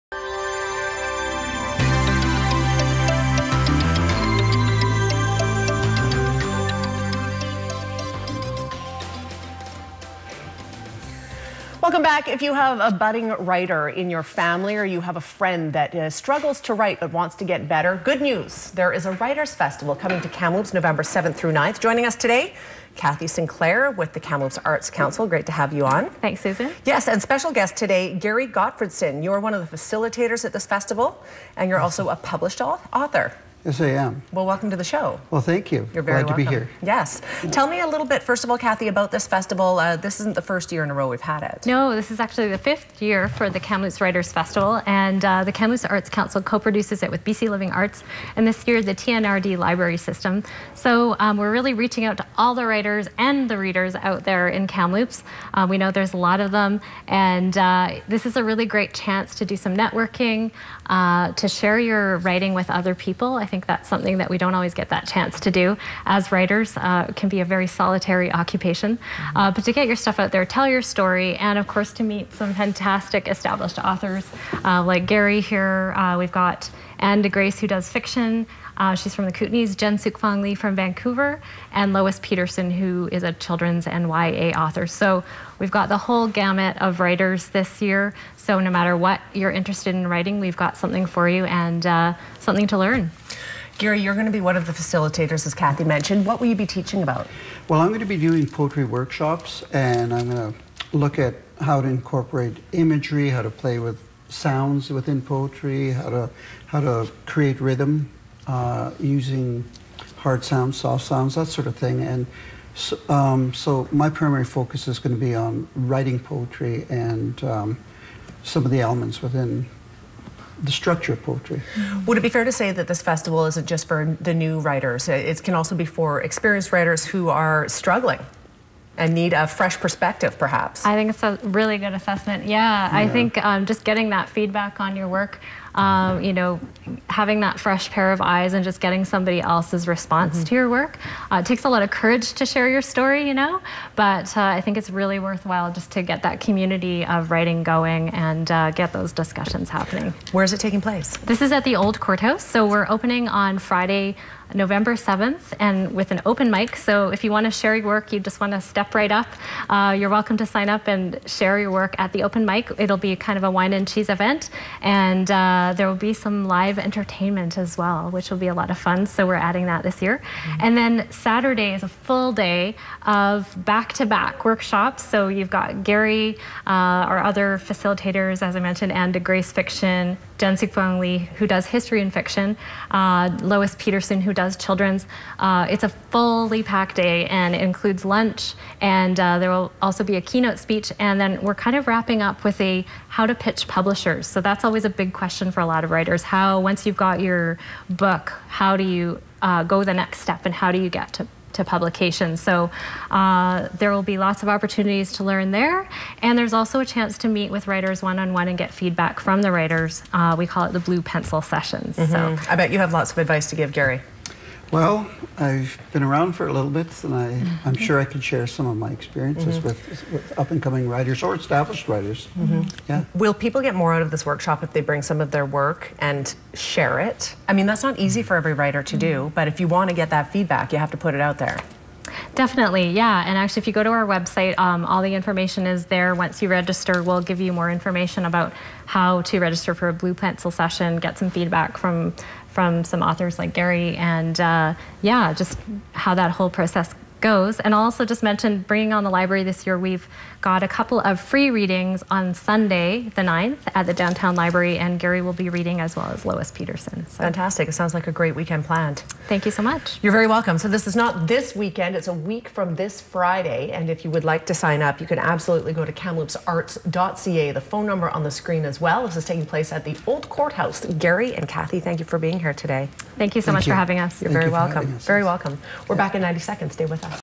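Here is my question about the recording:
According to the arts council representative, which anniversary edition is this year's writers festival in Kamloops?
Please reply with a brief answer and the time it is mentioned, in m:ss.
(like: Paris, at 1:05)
fifth, at 0:42.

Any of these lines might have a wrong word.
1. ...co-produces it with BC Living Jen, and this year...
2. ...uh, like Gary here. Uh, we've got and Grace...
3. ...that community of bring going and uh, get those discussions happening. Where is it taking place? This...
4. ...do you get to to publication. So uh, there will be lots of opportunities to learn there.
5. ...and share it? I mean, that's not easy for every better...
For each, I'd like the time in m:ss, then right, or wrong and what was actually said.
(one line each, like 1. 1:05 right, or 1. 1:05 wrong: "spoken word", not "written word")
1. 0:46 wrong: "Arts", not "Jen"
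2. 1:14 right
3. 2:26 wrong: "writing", not "bring"
4. 3:20 right
5. 3:45 wrong: "writer", not "better".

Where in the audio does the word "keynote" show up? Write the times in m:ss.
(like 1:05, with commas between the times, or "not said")
3:10.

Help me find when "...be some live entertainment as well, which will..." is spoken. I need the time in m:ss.
2:46.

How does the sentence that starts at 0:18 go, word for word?
There is a Writers Festival coming to Kamloops November 7th through 9th.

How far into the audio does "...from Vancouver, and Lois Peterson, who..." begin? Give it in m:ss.
1:20.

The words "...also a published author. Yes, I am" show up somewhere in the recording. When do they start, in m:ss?
0:31.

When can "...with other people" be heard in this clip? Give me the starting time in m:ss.
1:02.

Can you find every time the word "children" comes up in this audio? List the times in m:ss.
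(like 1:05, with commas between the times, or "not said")
1:23, 3:04.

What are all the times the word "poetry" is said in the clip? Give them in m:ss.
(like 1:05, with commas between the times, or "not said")
1:38, 1:45, 1:56, 2:01.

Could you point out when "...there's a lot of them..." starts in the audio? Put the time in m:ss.
0:55.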